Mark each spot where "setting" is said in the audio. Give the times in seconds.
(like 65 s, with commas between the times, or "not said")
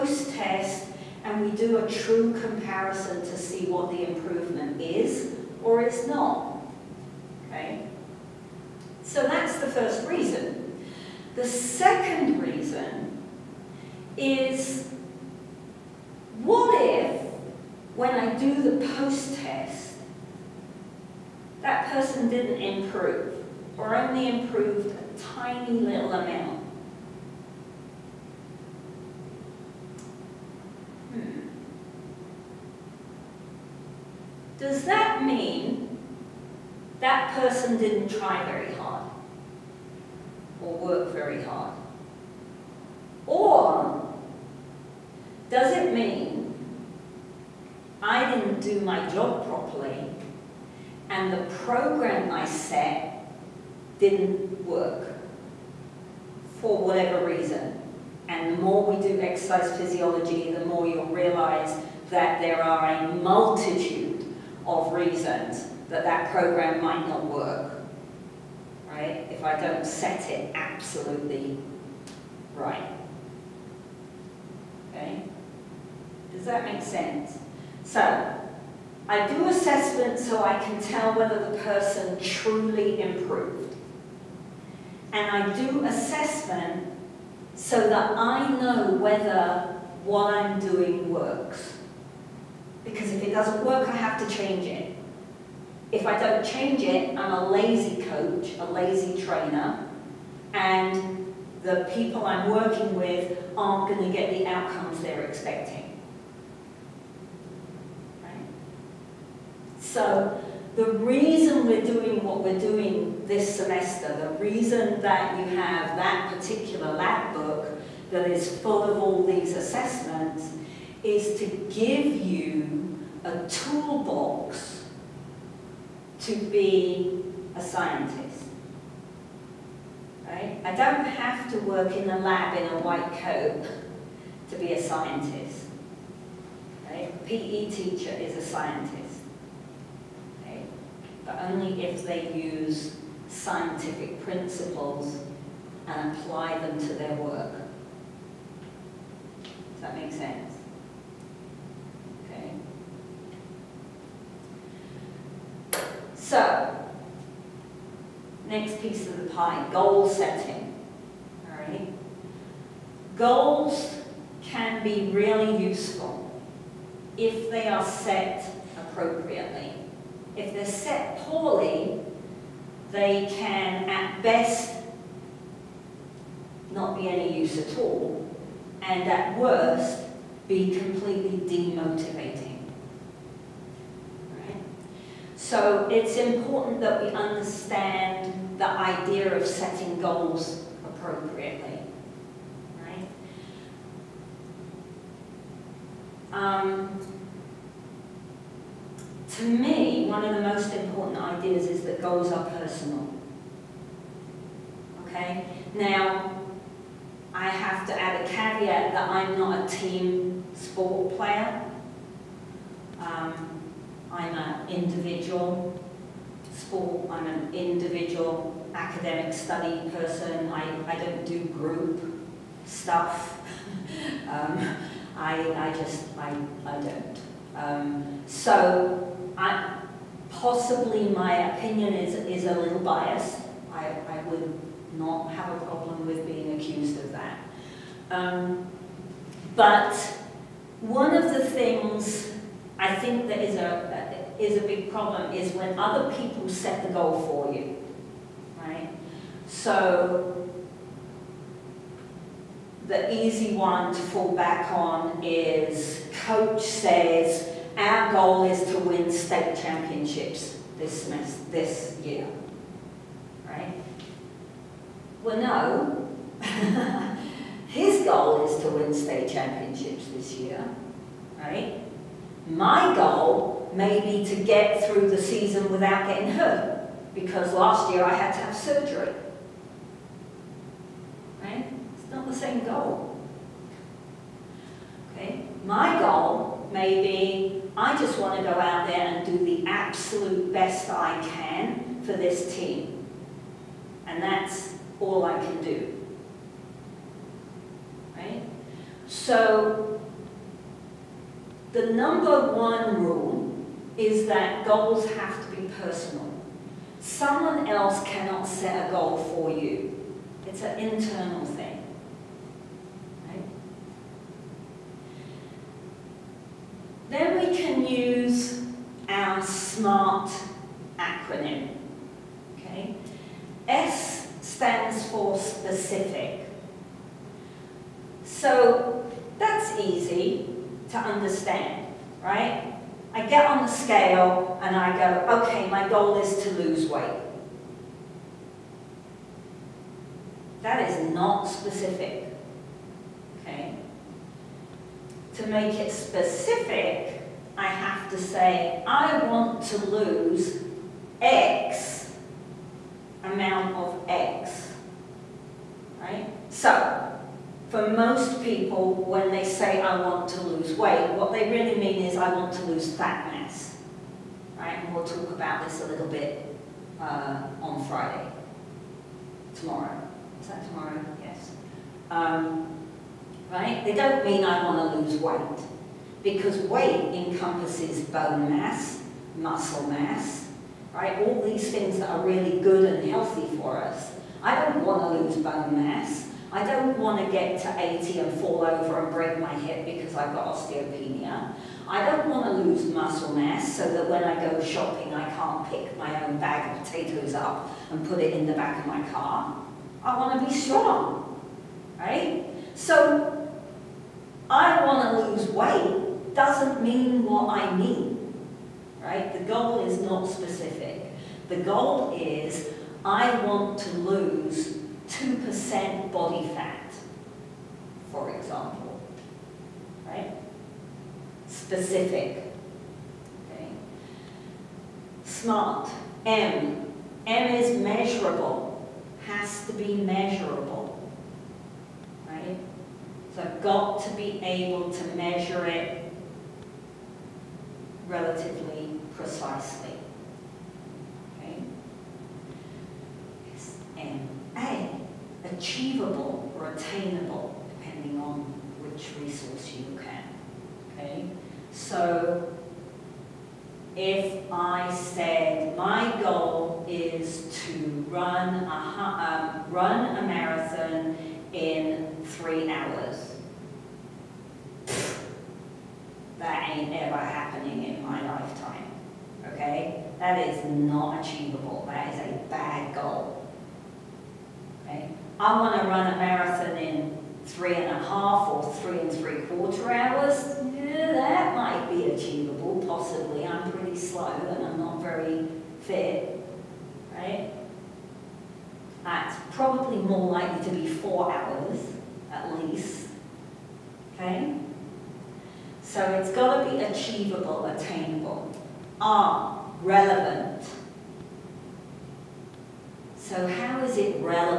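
160 s, 189 s.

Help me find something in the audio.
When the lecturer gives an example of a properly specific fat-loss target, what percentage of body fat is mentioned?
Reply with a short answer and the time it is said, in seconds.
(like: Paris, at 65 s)
2%, at 415 s.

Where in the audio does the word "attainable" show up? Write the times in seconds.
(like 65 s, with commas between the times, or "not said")
446 s, 497 s.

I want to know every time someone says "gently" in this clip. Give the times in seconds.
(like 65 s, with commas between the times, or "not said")
not said.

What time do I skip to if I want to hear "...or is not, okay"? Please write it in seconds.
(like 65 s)
5 s.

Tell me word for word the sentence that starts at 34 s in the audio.
does that mean that person didn't try very hard or work very hard?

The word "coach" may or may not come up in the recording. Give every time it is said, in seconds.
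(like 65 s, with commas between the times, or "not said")
98 s, 256 s.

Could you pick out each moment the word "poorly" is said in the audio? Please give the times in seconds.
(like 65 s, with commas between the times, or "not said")
171 s.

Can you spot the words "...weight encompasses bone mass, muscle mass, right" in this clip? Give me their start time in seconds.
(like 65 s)
376 s.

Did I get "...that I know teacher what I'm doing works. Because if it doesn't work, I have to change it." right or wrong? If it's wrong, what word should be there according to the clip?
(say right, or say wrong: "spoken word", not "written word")
wrong: "whether", not "teacher".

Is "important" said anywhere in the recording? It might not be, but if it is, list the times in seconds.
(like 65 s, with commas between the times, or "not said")
186 s, 200 s.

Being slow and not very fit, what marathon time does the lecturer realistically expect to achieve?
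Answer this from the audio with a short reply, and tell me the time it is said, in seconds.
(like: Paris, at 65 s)
4 hours, at 490 s.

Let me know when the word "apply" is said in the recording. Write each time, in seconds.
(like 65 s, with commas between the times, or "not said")
146 s.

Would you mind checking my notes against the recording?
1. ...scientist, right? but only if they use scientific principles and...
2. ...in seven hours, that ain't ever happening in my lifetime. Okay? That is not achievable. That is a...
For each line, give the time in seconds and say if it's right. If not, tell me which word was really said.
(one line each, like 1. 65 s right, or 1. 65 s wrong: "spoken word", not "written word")
1. 138 s right
2. 461 s wrong: "three", not "seven".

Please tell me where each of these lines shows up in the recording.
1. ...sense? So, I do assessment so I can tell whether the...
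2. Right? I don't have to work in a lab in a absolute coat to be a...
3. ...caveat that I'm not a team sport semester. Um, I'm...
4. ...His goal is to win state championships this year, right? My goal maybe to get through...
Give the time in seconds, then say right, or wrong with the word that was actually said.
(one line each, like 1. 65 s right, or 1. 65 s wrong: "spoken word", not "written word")
1. 76 s right
2. 130 s wrong: "white", not "absolute"
3. 208 s wrong: "player", not "semester"
4. 267 s right.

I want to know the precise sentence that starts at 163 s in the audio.
Goals can be really useful if they are set appropriately.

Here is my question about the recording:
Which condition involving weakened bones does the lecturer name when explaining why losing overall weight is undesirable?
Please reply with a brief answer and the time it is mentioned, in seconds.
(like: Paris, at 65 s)
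osteopenia, at 390 s.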